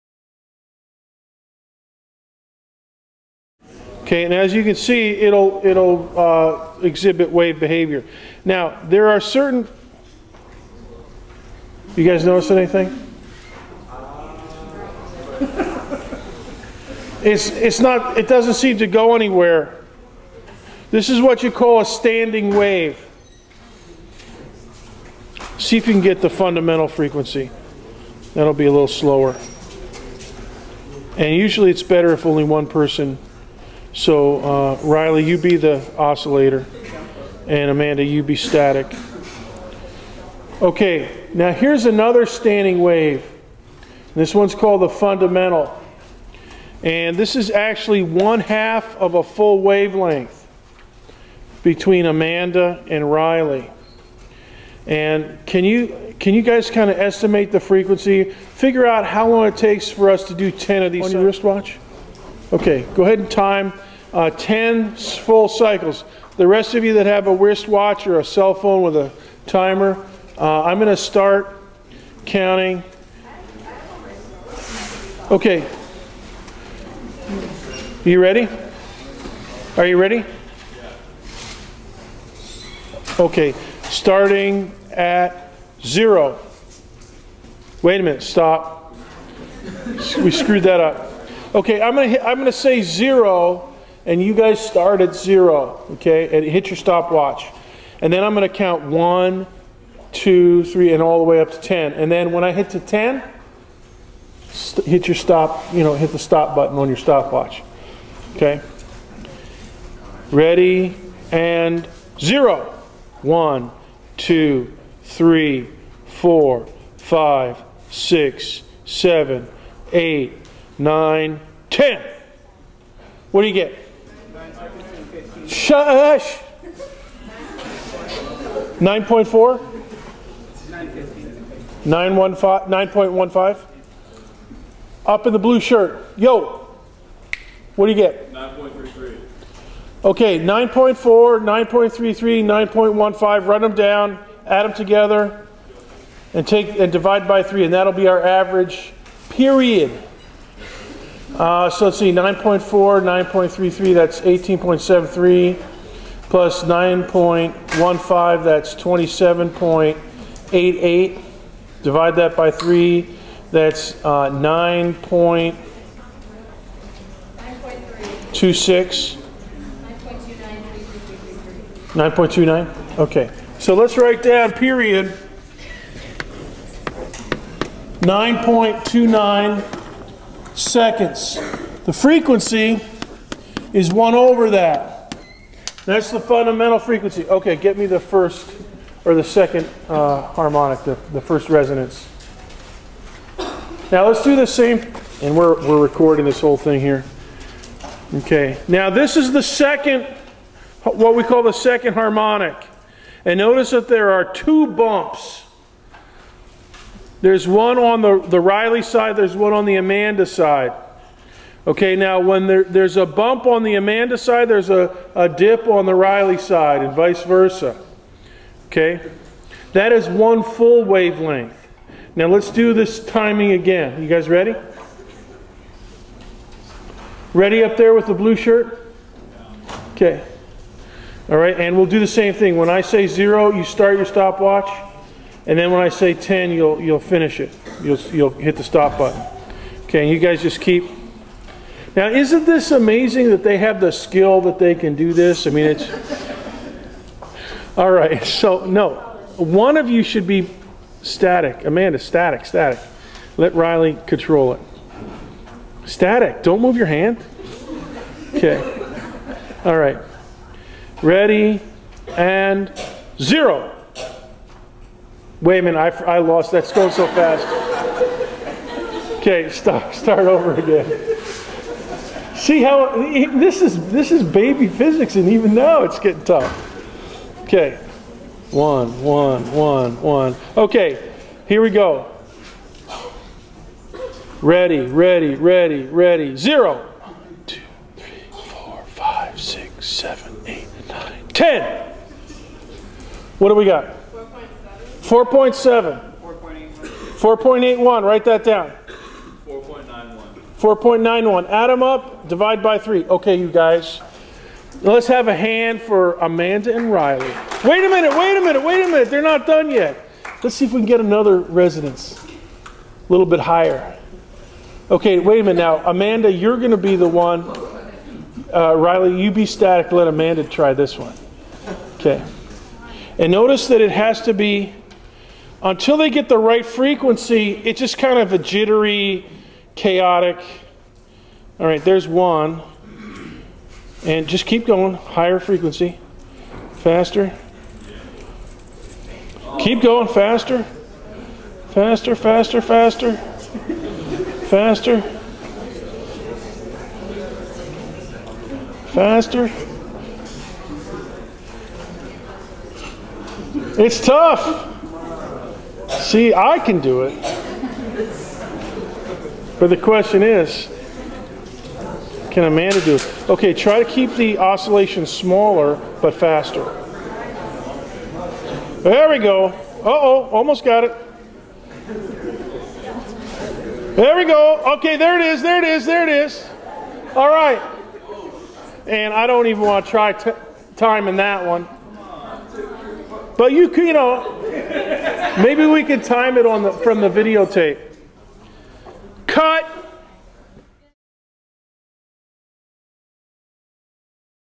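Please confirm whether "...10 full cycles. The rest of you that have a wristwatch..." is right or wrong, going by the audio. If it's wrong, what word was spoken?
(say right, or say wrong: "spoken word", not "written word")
right.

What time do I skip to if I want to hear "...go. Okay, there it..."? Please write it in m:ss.
6:14.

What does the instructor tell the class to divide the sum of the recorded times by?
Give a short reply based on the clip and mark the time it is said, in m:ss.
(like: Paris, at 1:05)
3, at 5:02.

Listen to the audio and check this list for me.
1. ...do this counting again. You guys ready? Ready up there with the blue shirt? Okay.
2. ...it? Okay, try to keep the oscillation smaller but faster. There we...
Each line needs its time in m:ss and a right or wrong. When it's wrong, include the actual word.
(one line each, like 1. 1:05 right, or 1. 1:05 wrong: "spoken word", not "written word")
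1. 3:42 wrong: "timing", not "counting"
2. 6:02 right.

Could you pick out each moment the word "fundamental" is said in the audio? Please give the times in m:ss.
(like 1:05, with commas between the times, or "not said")
0:26, 0:44, 3:06.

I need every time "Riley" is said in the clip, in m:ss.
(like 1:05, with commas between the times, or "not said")
0:34, 0:53, 3:28, 3:35, 4:13, 5:06, 5:18.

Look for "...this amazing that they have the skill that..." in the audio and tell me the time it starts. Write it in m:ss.
4:02.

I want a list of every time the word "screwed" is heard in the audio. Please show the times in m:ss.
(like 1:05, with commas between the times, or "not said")
1:30.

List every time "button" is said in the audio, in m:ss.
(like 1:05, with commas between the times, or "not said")
1:46, 3:58.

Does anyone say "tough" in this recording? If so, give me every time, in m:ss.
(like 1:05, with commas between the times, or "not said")
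4:36, 5:54.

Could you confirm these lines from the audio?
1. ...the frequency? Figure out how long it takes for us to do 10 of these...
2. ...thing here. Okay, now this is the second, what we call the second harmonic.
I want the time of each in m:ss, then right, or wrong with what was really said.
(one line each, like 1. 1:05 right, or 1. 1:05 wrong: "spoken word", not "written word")
1. 0:57 right
2. 3:16 right.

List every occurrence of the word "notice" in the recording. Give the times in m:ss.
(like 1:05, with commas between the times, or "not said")
0:12, 3:23, 5:23.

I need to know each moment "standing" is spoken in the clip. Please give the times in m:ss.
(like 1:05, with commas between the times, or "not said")
0:21, 0:42.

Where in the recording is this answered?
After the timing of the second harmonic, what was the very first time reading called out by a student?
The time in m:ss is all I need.
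4:55.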